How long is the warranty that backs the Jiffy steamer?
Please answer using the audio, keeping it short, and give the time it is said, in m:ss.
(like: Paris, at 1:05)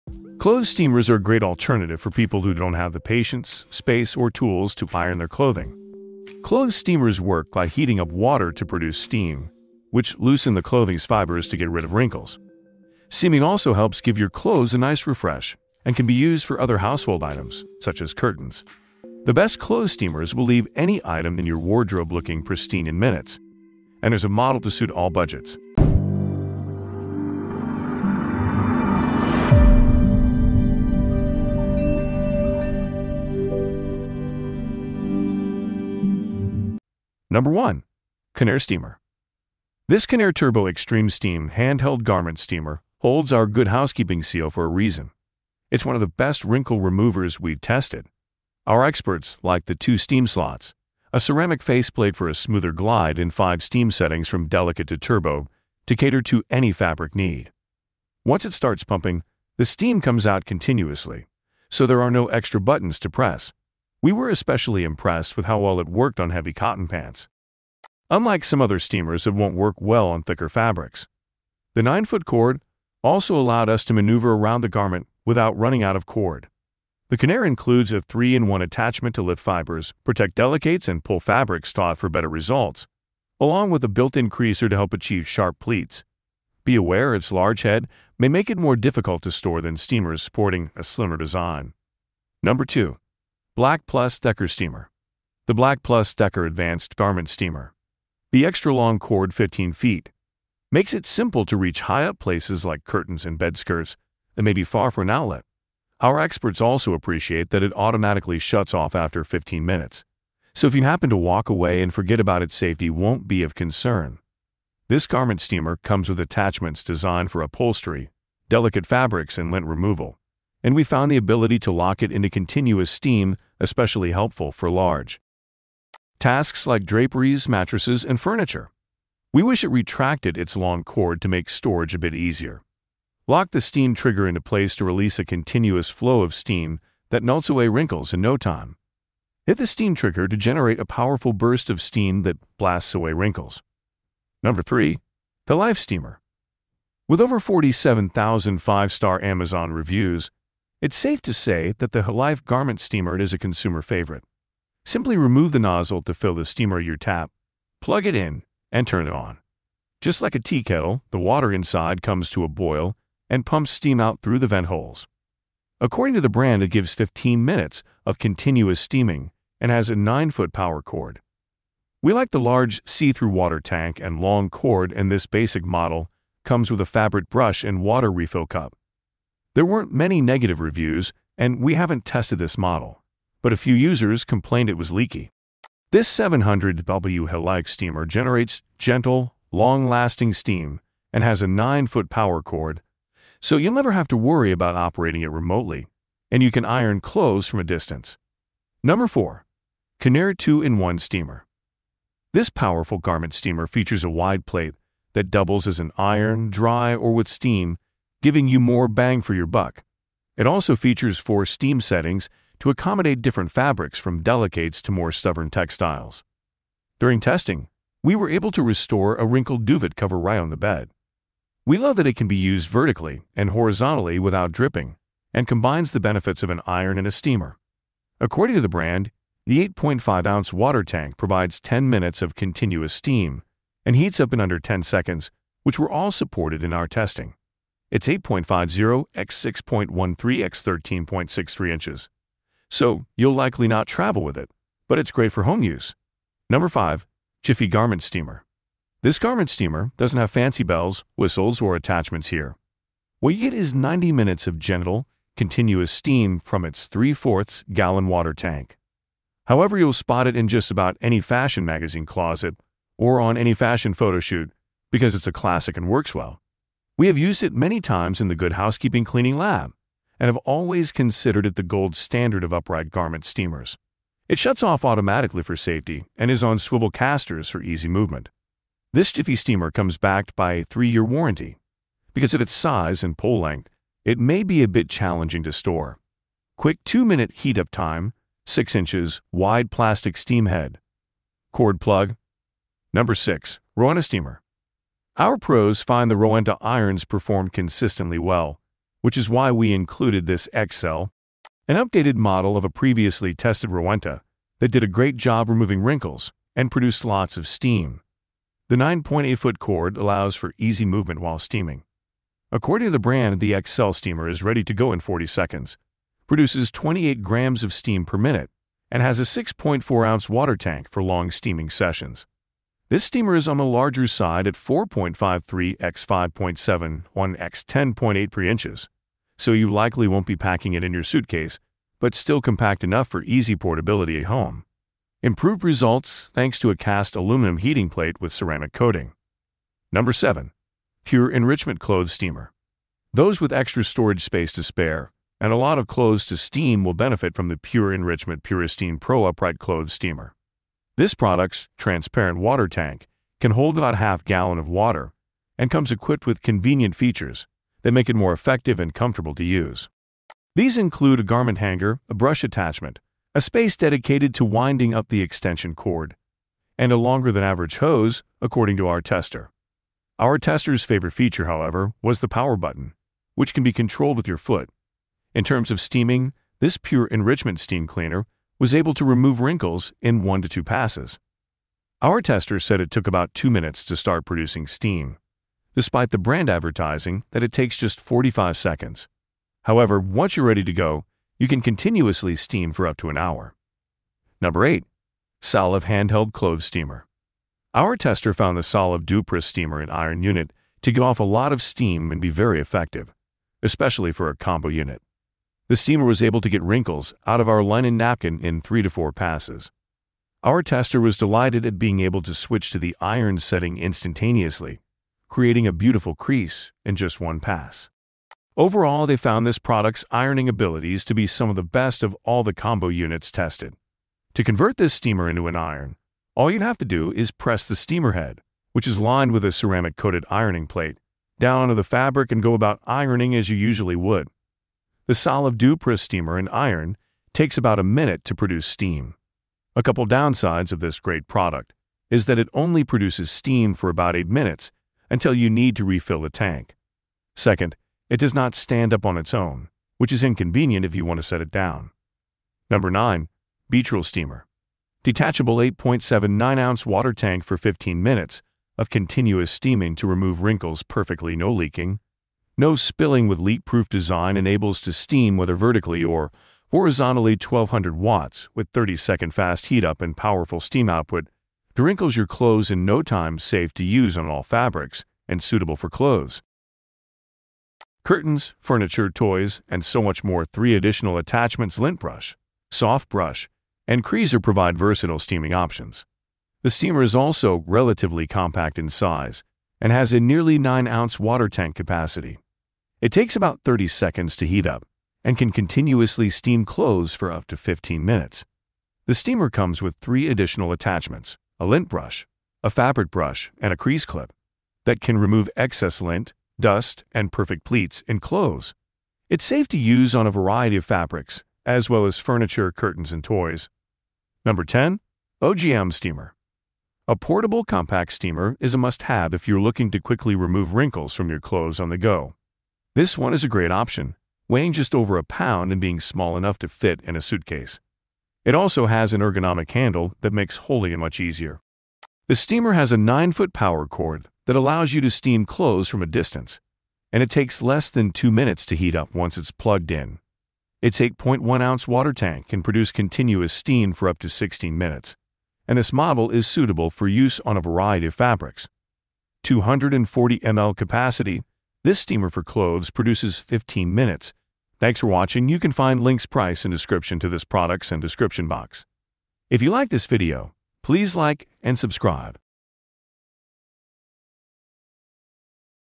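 3 years, at 4:40.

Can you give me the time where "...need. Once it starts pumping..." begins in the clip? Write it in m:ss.
0:57.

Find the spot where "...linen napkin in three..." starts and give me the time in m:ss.
6:47.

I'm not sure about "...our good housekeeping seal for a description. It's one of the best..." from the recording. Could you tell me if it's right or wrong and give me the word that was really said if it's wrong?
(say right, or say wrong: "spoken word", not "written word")
wrong: "reason", not "description".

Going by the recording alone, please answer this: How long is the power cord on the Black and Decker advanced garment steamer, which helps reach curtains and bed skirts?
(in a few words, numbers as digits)
15 feet.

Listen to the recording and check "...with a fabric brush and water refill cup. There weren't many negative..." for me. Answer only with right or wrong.
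right.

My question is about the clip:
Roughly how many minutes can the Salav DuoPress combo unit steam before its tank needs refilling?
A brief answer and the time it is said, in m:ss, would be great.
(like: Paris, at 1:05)
8 minutes, at 7:24.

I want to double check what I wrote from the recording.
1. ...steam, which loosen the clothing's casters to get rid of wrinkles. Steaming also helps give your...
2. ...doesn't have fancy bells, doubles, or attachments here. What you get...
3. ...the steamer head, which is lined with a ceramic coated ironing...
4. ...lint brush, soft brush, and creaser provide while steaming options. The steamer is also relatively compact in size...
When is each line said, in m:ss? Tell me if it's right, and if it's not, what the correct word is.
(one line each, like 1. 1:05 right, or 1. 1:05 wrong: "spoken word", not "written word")
1. 0:08 wrong: "fibers", not "casters"
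2. 4:09 wrong: "whistles", not "doubles"
3. 7:07 right
4. 8:01 wrong: "versatile", not "while".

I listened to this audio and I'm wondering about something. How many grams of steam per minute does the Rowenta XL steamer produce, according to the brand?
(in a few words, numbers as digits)
28 grams.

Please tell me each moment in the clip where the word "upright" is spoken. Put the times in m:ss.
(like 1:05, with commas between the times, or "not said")
4:32, 5:49.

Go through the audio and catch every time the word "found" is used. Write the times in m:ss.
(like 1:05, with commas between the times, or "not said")
2:00, 6:38, 6:59.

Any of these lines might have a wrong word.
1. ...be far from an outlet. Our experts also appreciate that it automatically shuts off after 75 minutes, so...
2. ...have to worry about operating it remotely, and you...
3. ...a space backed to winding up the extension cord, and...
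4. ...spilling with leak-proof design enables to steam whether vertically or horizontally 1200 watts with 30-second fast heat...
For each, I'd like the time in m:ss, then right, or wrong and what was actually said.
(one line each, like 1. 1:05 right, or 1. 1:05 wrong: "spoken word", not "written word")
1. 1:44 wrong: "15", not "75"
2. 3:13 right
3. 6:03 wrong: "dedicated", not "backed"
4. 7:42 right.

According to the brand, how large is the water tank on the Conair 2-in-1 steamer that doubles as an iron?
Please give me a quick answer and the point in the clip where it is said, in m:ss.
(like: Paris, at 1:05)
8.5 ounces, at 3:49.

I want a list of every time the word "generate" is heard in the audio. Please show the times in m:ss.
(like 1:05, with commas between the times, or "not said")
2:20, 3:08.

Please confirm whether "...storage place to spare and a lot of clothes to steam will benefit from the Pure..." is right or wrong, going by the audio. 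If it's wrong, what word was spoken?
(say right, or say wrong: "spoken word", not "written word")
wrong: "space", not "place".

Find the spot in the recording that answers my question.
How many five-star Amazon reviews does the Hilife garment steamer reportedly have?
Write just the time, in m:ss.
2:27.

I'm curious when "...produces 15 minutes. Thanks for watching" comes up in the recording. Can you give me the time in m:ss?
9:12.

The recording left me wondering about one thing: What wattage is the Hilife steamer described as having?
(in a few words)
700W.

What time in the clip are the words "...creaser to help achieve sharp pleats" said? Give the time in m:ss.
1:24.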